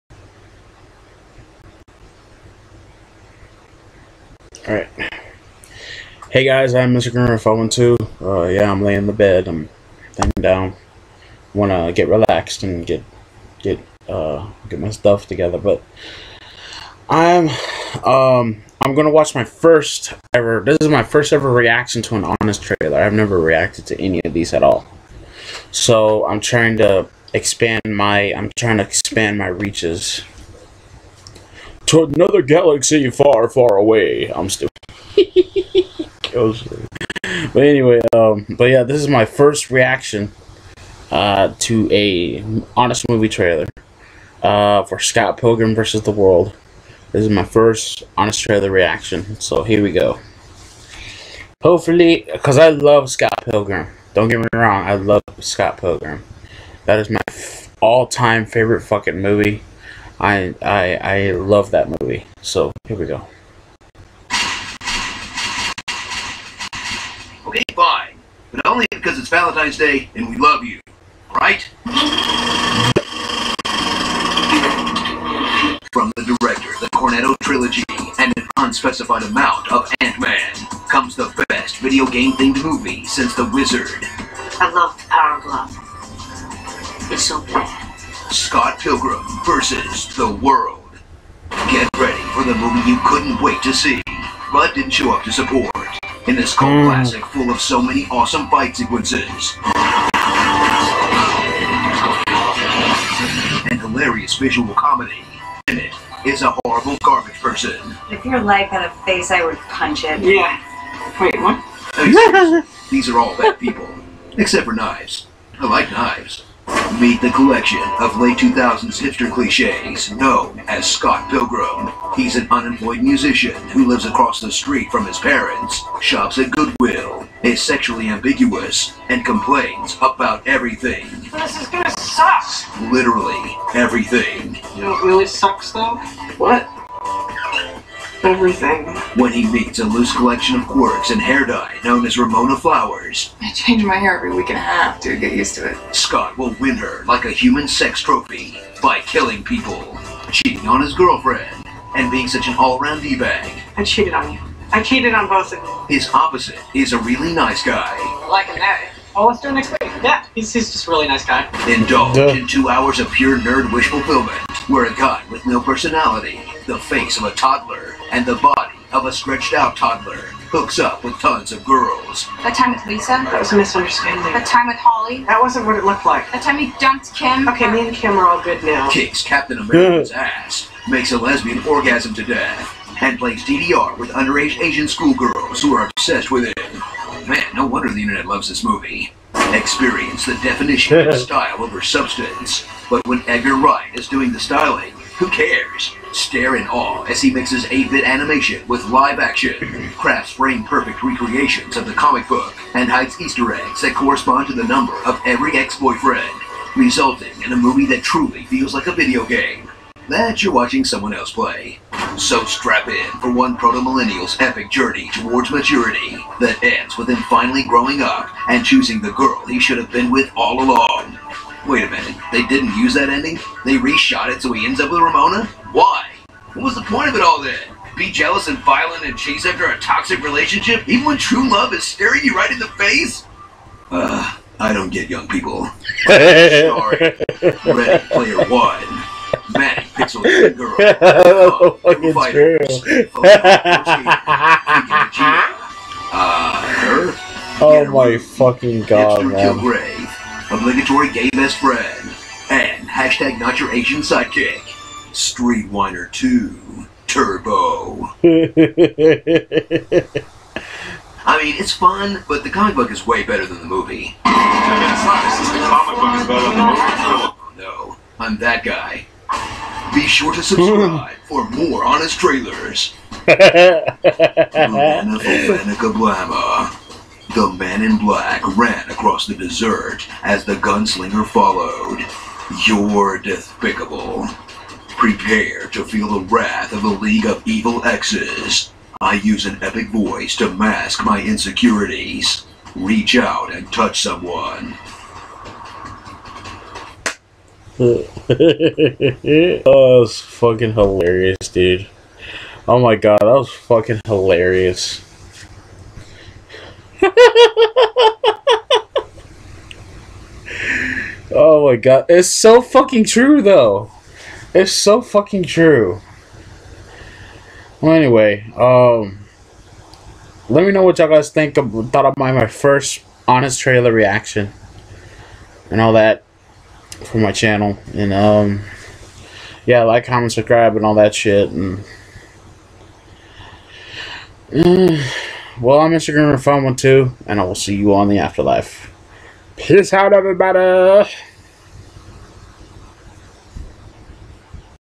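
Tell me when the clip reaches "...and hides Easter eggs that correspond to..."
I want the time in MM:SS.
03:22.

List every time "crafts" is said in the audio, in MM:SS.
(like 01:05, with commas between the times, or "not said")
03:19.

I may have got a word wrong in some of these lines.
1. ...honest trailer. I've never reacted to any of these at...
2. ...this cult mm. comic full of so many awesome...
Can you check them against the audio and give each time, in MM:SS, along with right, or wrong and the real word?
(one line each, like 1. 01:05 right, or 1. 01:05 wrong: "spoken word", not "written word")
1. 00:22 right
2. 01:36 wrong: "classic", not "comic".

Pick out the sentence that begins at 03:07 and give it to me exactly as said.
Man, no wonder the internet loves this movie.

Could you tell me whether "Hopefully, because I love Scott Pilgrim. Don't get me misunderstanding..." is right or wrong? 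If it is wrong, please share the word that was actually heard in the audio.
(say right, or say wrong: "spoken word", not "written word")
wrong: "wrong", not "misunderstanding".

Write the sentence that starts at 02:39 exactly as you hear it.
Oh, let's do it next week.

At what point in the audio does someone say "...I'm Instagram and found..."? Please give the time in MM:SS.
05:35.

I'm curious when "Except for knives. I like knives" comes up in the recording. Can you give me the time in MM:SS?
01:54.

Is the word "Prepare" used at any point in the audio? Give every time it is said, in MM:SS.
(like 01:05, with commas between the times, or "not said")
04:44.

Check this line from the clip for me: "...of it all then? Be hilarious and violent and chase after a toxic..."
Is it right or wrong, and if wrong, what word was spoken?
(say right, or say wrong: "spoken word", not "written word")
wrong: "jealous", not "hilarious".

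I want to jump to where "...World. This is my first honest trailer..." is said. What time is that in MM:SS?
00:46.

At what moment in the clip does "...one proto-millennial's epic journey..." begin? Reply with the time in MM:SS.
03:33.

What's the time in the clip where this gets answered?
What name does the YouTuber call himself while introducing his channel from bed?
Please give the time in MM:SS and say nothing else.
00:06.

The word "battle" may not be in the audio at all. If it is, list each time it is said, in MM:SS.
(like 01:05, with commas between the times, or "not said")
not said.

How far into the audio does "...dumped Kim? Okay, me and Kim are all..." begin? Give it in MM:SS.
02:56.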